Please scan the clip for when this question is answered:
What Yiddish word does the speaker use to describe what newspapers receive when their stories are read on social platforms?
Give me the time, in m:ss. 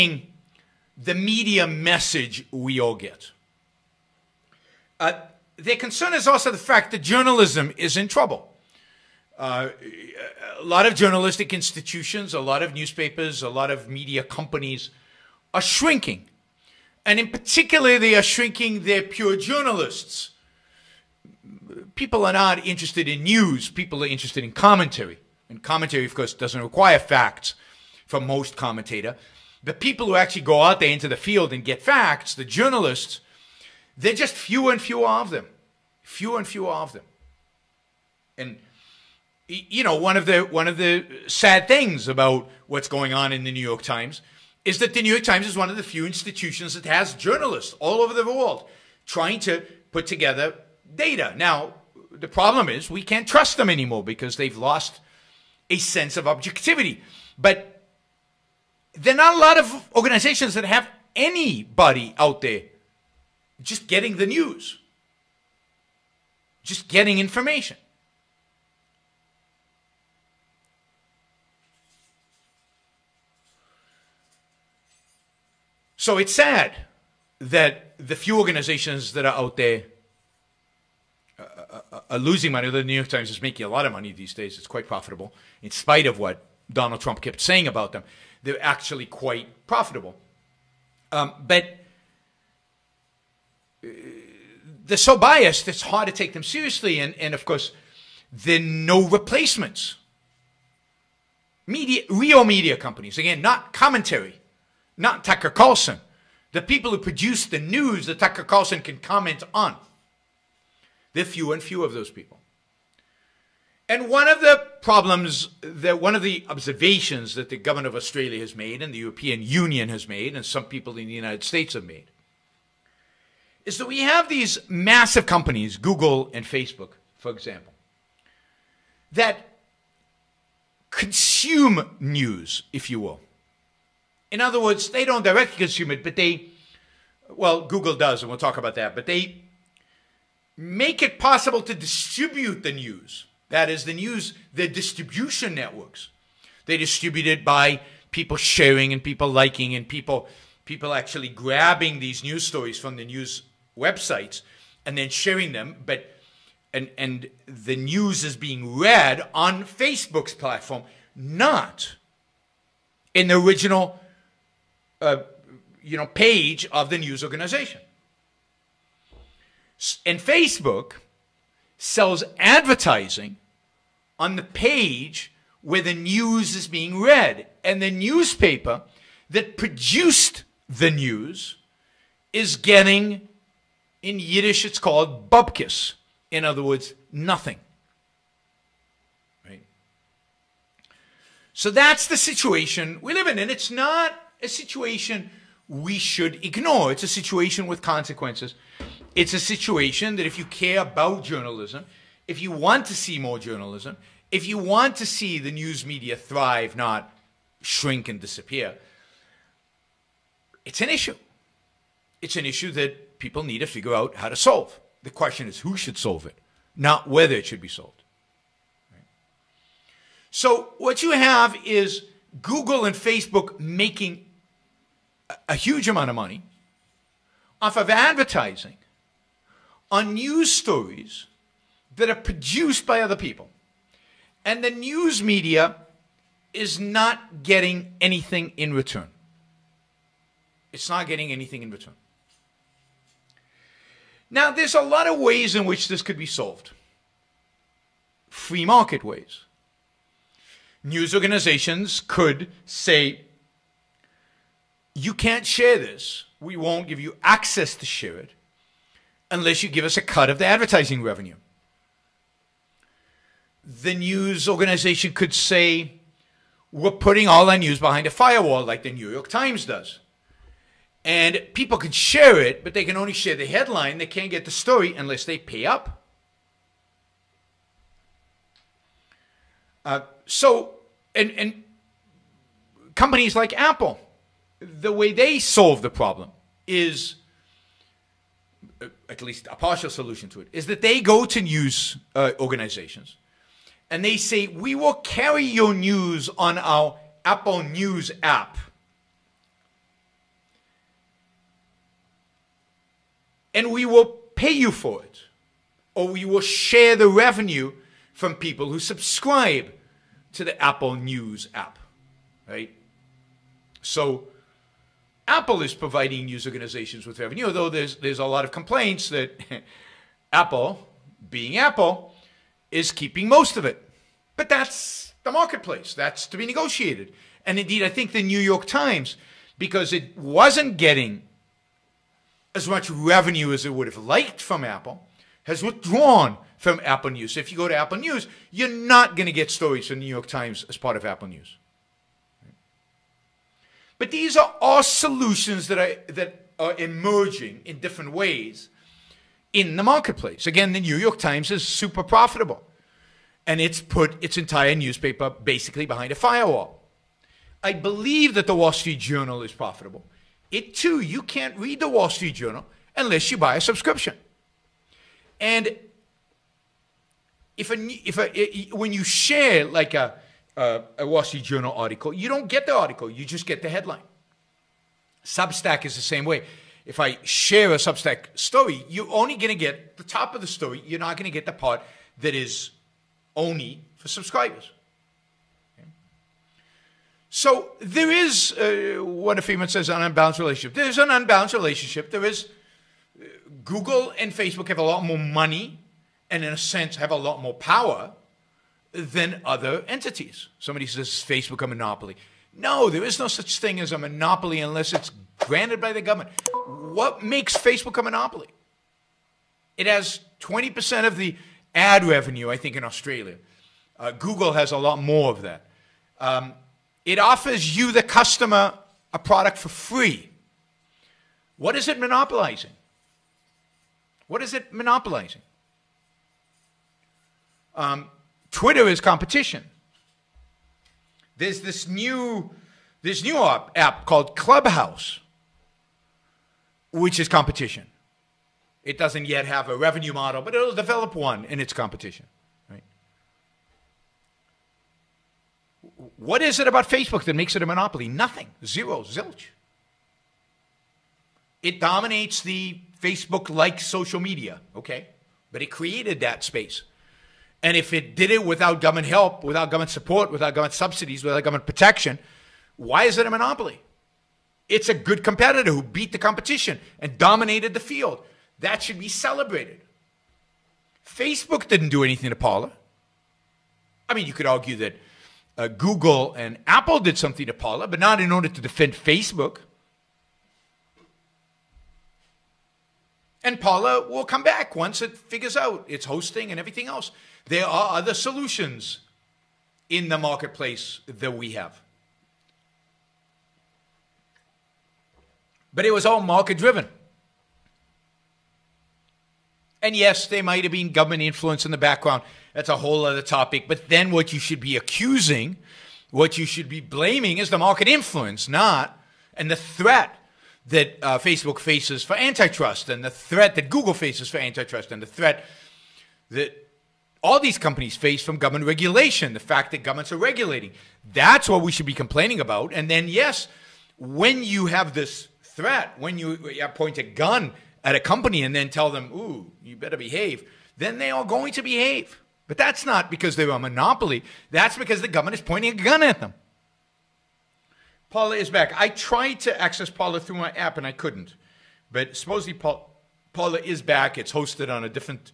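3:05.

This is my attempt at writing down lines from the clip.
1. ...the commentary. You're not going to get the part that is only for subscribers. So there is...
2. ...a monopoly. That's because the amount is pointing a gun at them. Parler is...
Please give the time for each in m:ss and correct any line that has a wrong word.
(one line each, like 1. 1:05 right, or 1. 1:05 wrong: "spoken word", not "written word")
1. 6:20 wrong: "story", not "commentary"
2. 8:53 wrong: "government", not "amount".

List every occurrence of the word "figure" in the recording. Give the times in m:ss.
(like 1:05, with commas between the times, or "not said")
3:33, 8:05.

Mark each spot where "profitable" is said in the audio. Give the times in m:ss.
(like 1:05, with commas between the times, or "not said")
1:24, 1:29, 5:52, 5:59.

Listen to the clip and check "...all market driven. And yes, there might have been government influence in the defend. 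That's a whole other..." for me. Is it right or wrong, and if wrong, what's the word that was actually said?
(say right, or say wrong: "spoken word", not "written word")
wrong: "background", not "defend".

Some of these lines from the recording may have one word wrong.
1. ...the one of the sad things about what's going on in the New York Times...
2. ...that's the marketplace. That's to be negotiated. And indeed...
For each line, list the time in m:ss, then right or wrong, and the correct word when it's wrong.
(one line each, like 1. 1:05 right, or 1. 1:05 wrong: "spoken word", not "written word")
1. 0:40 right
2. 5:24 right.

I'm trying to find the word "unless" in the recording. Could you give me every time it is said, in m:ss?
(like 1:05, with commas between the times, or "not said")
4:19, 4:34, 6:02, 6:44.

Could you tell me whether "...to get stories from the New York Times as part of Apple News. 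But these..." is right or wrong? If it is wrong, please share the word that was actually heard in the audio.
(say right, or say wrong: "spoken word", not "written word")
right.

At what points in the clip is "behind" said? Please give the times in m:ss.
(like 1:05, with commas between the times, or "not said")
4:27, 5:55.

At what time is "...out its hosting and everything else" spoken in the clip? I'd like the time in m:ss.
8:05.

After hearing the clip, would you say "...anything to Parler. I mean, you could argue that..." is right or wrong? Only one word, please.
right.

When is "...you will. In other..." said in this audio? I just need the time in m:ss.
2:12.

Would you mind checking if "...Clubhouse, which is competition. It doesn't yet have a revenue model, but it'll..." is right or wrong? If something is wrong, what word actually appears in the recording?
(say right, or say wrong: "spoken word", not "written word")
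right.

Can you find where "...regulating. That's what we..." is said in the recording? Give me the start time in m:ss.
8:40.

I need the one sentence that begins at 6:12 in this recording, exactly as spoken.
You don't get the article, you just get the headline.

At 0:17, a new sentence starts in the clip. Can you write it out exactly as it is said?
And in particular, they are shrinking their pure journalists.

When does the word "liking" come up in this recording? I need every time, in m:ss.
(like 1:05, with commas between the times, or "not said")
2:29.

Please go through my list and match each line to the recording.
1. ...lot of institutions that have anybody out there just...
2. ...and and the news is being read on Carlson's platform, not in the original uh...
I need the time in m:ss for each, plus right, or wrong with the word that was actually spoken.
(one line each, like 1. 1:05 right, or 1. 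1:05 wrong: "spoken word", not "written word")
1. 0:59 wrong: "organizations", not "institutions"
2. 2:36 wrong: "Facebook", not "Carlson".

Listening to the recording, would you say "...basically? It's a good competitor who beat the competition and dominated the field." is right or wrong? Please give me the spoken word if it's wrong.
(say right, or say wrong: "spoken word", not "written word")
wrong: "monopoly", not "basically".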